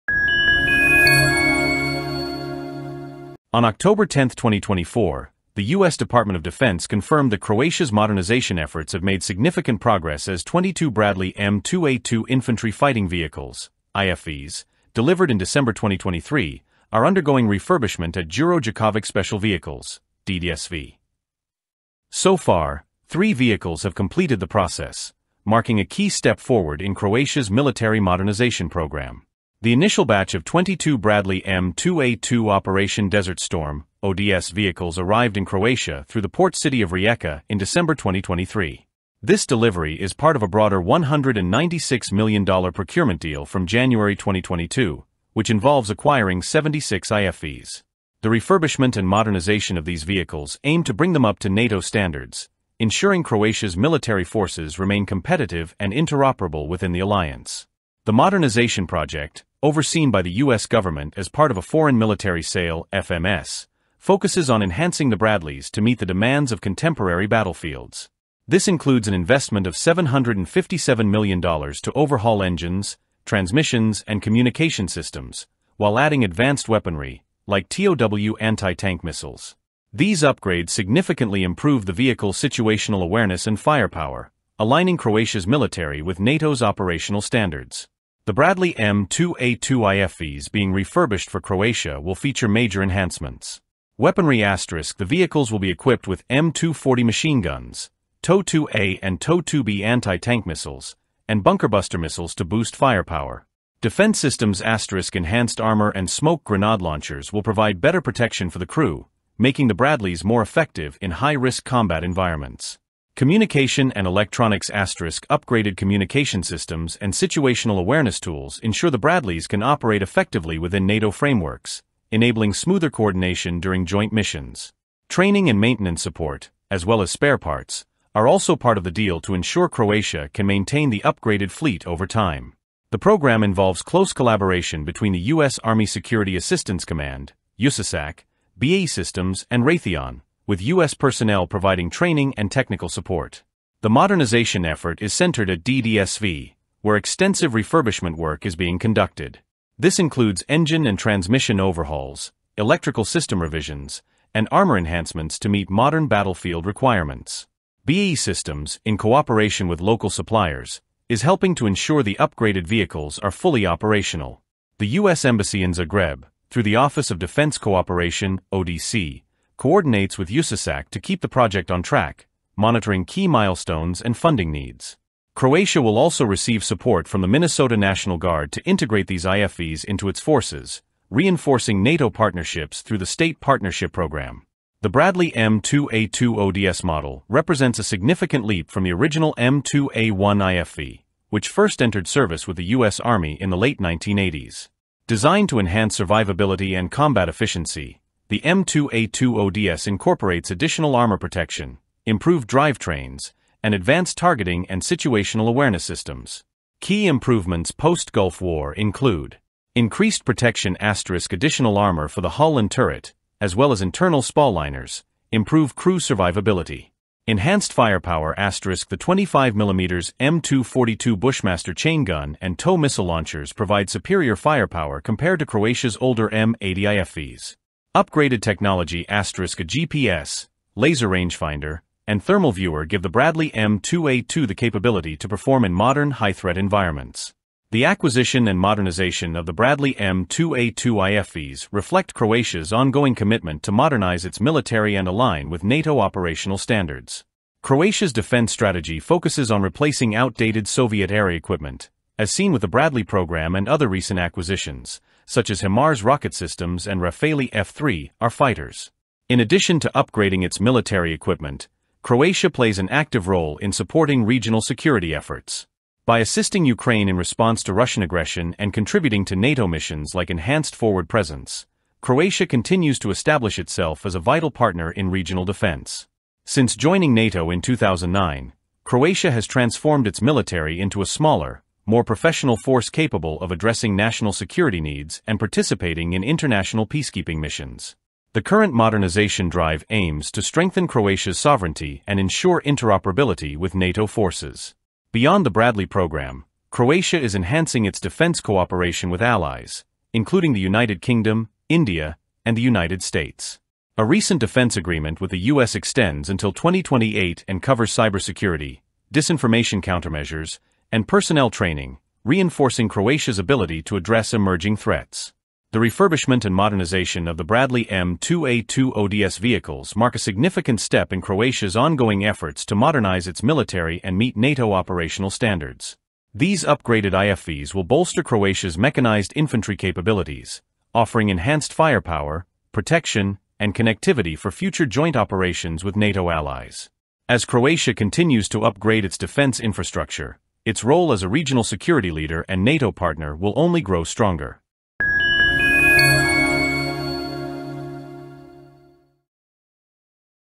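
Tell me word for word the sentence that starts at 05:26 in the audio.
These upgraded IFVs will bolster Croatia's mechanized infantry capabilities, offering enhanced firepower, protection, and connectivity for future joint operations with NATO allies.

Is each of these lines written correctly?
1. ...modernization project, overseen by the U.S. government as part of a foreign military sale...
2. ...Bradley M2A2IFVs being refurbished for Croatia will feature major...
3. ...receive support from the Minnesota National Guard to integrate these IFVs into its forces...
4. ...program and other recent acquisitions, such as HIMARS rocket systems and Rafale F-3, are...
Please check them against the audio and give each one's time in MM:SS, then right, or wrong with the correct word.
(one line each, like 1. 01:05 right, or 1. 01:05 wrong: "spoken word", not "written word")
1. 00:58 right
2. 01:28 right
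3. 02:56 right
4. 04:13 right.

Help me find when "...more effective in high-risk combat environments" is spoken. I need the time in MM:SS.
01:50.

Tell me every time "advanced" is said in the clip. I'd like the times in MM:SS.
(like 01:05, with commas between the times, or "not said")
01:16, 03:23.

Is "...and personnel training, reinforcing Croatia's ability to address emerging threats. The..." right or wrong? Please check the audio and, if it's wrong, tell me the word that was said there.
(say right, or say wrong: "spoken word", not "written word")
right.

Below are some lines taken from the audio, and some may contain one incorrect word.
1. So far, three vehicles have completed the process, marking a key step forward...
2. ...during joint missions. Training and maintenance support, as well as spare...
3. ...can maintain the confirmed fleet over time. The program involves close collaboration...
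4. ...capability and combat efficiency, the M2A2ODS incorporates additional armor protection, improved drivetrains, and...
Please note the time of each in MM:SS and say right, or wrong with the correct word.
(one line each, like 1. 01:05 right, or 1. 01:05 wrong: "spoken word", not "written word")
1. 00:22 right
2. 02:03 right
3. 02:10 wrong: "upgraded", not "confirmed"
4. 03:15 wrong: "survivability", not "capability".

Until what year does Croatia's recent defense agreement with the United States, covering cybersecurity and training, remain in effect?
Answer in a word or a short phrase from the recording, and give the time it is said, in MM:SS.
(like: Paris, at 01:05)
2028, at 05:06.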